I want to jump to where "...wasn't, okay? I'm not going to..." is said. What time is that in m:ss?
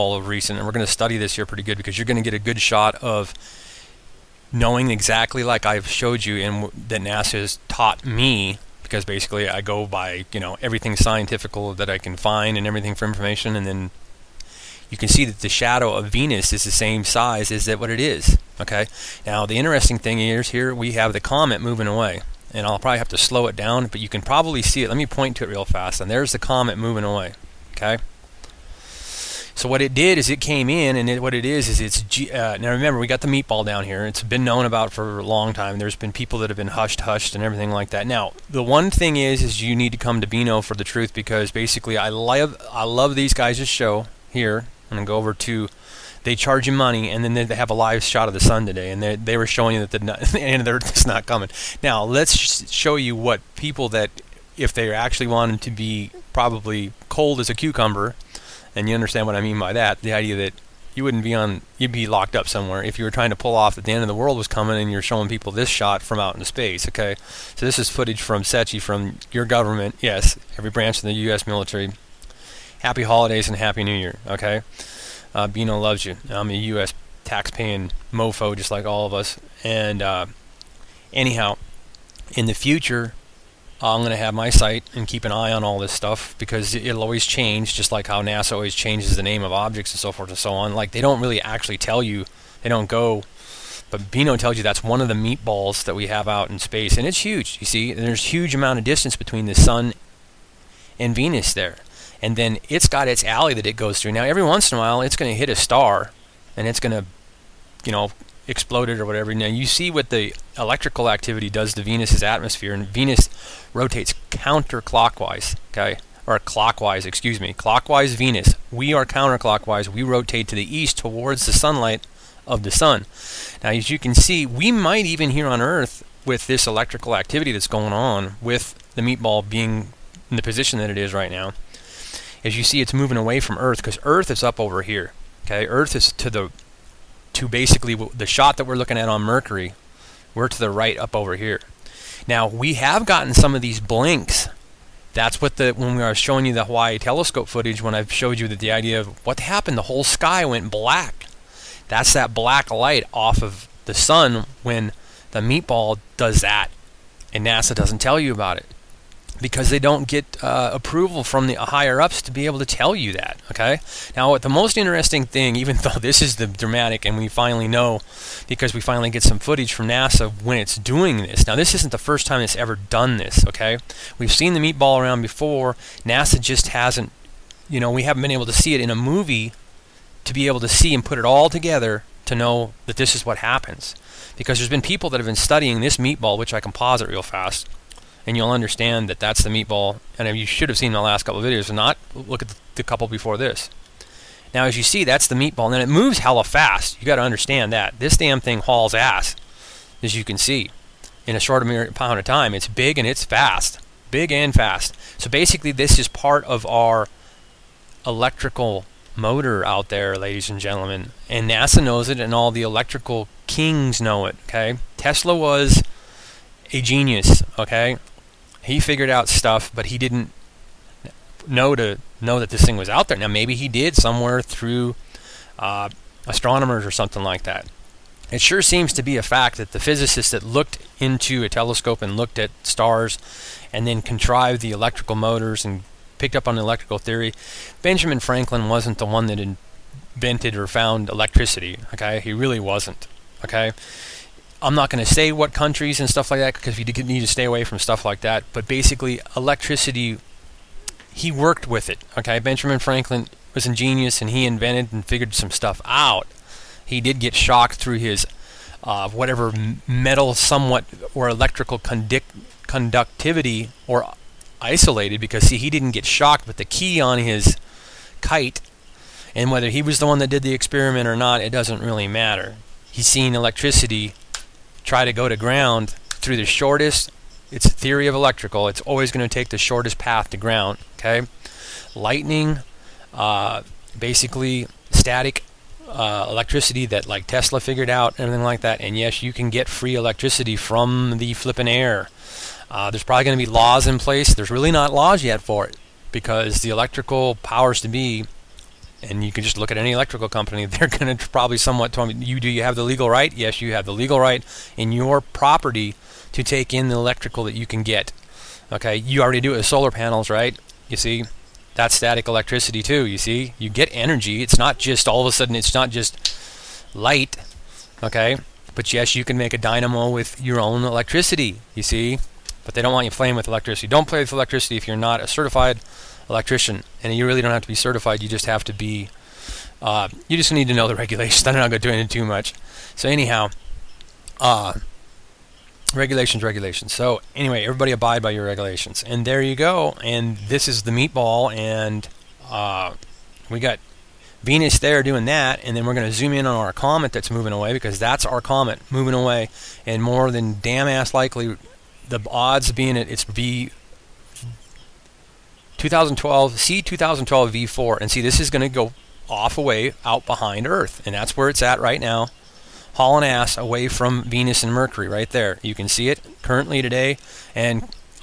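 4:02.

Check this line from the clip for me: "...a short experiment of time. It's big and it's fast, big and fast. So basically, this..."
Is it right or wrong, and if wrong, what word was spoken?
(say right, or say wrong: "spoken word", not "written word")
wrong: "amount", not "experiment".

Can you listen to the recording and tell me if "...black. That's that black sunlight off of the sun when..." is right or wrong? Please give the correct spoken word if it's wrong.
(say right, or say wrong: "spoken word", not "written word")
wrong: "light", not "sunlight".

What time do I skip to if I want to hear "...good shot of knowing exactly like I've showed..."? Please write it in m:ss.
0:02.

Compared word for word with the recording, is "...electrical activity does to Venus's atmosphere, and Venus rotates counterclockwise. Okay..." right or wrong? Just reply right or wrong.
right.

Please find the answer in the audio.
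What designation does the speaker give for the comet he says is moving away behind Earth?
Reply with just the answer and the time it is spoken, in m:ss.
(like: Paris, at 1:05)
2012 V4, at 5:56.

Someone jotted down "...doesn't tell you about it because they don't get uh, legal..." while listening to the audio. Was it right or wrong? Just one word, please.
wrong.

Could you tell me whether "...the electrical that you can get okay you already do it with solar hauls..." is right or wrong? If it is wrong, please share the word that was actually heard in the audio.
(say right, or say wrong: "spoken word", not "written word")
wrong: "panels", not "hauls".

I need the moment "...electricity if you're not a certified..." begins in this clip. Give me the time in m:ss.
5:24.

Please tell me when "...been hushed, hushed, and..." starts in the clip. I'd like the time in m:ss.
0:36.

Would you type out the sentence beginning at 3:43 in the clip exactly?
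Now maybe he did somewhere through uh, astronomers or something like that.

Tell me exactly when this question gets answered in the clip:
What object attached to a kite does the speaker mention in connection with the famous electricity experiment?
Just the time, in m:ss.
4:26.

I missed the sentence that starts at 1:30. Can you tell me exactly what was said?
Like, they don't really actually tell you, they don't go.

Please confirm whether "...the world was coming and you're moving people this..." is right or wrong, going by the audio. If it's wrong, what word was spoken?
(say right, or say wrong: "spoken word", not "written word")
wrong: "showing", not "moving".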